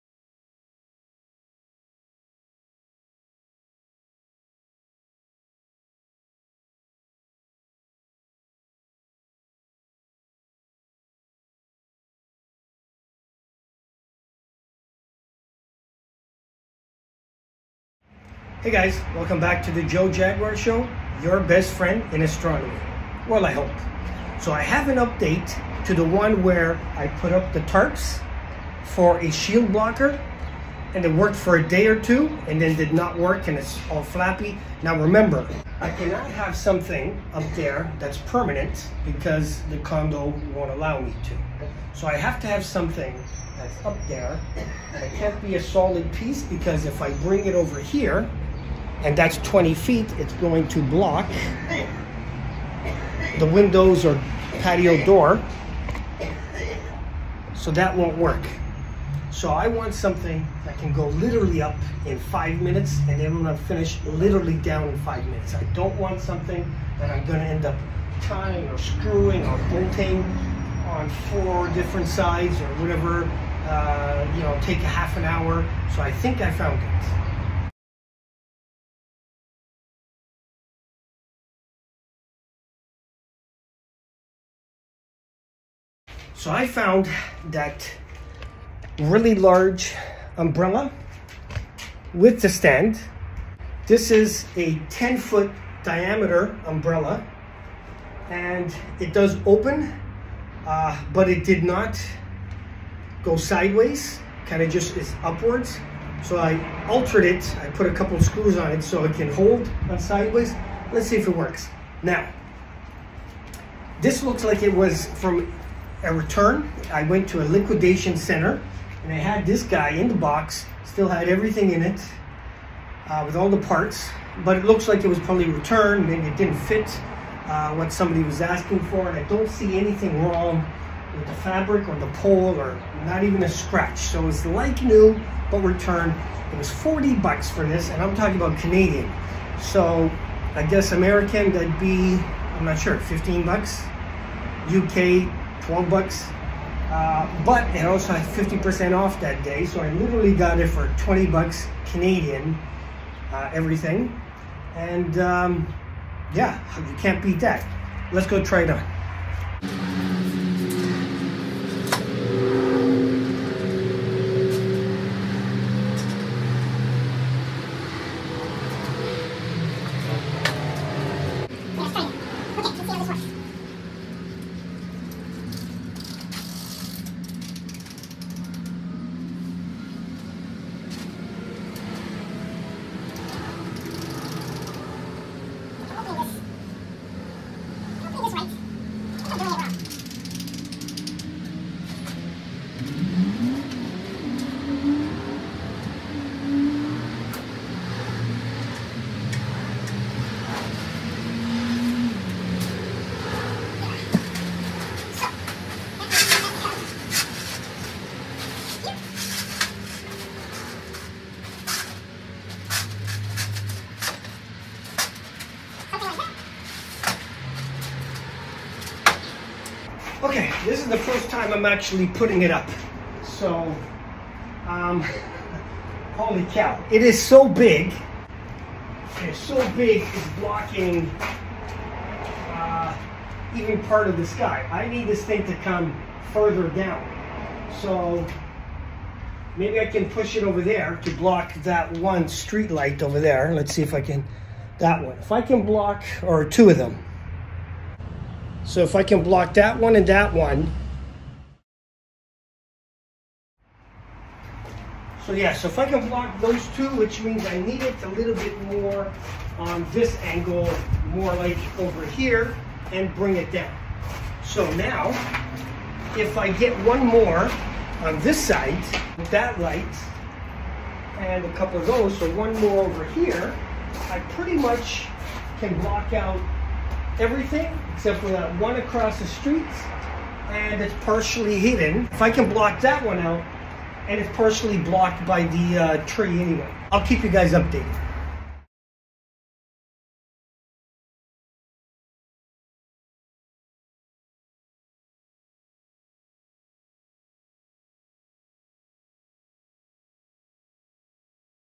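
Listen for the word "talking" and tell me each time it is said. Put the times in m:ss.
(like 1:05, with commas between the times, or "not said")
2:18.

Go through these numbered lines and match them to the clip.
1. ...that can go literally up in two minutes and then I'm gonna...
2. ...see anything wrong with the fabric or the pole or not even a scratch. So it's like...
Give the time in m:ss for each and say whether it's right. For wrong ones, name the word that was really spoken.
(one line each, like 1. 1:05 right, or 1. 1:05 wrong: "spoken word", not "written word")
1. 1:00 wrong: "five", not "two"
2. 2:09 right.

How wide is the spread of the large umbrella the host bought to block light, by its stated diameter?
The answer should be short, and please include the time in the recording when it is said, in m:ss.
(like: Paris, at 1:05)
10 feet, at 1:34.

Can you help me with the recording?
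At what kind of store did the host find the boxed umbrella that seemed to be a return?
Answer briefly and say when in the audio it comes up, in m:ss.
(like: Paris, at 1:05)
liquidation center, at 1:57.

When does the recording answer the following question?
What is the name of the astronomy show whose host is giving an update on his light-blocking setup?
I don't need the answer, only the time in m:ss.
0:19.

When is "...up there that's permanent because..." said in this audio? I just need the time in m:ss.
0:37.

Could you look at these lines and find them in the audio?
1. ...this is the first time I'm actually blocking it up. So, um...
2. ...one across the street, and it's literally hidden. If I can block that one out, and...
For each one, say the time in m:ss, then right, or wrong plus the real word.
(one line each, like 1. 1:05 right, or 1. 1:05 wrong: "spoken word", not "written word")
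1. 3:40 wrong: "putting", not "blocking"
2. 4:38 wrong: "partially", not "literally".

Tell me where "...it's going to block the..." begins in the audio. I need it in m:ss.
0:50.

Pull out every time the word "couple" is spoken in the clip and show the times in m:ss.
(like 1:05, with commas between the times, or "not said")
1:47, 4:31.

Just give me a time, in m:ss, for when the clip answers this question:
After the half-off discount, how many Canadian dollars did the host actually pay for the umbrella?
2:30.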